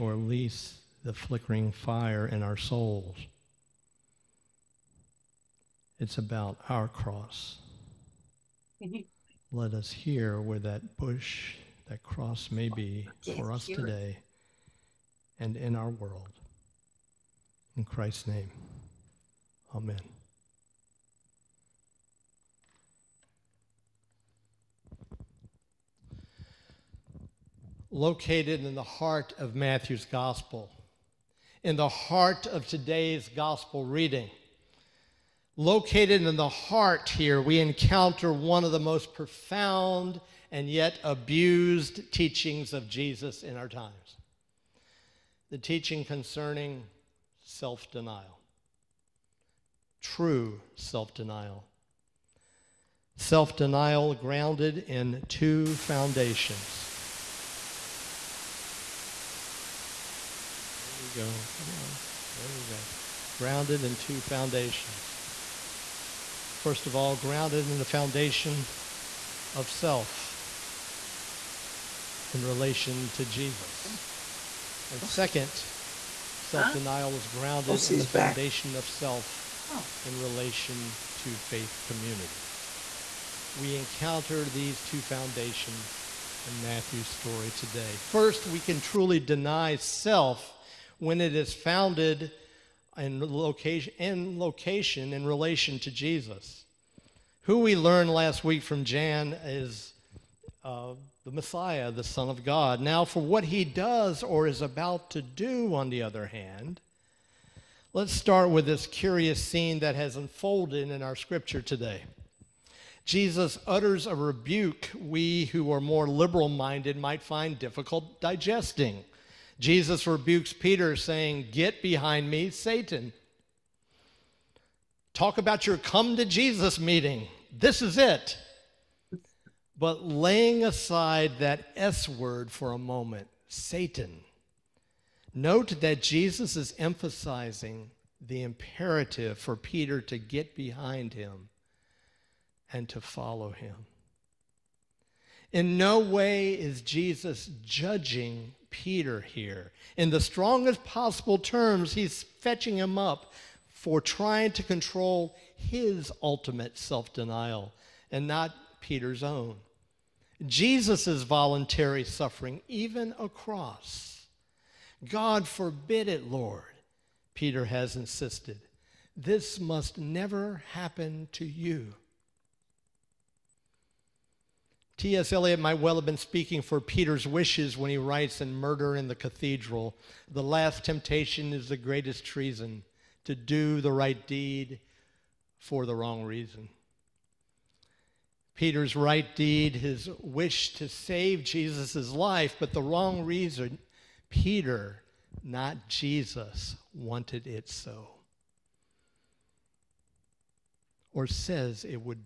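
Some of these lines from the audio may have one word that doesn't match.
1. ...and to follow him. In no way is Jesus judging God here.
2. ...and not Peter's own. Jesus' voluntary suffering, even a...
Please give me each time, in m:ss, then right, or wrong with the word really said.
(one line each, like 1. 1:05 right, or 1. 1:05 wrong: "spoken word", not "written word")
1. 2:22 wrong: "Peter", not "God"
2. 2:38 right.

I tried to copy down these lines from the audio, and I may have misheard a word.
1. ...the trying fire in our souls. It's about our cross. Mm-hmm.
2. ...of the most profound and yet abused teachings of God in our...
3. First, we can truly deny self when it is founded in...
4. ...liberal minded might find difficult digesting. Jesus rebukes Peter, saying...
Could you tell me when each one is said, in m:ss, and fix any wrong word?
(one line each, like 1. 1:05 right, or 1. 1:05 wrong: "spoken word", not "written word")
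1. 0:01 wrong: "flickering", not "trying"
2. 0:38 wrong: "Jesus", not "God"
3. 1:28 right
4. 1:56 right.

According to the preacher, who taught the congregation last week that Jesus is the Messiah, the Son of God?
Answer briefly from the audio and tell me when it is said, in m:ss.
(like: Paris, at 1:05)
Jan, at 1:38.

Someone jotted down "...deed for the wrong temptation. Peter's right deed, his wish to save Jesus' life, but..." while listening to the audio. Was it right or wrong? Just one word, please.
wrong.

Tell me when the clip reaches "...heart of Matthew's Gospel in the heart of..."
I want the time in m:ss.
0:28.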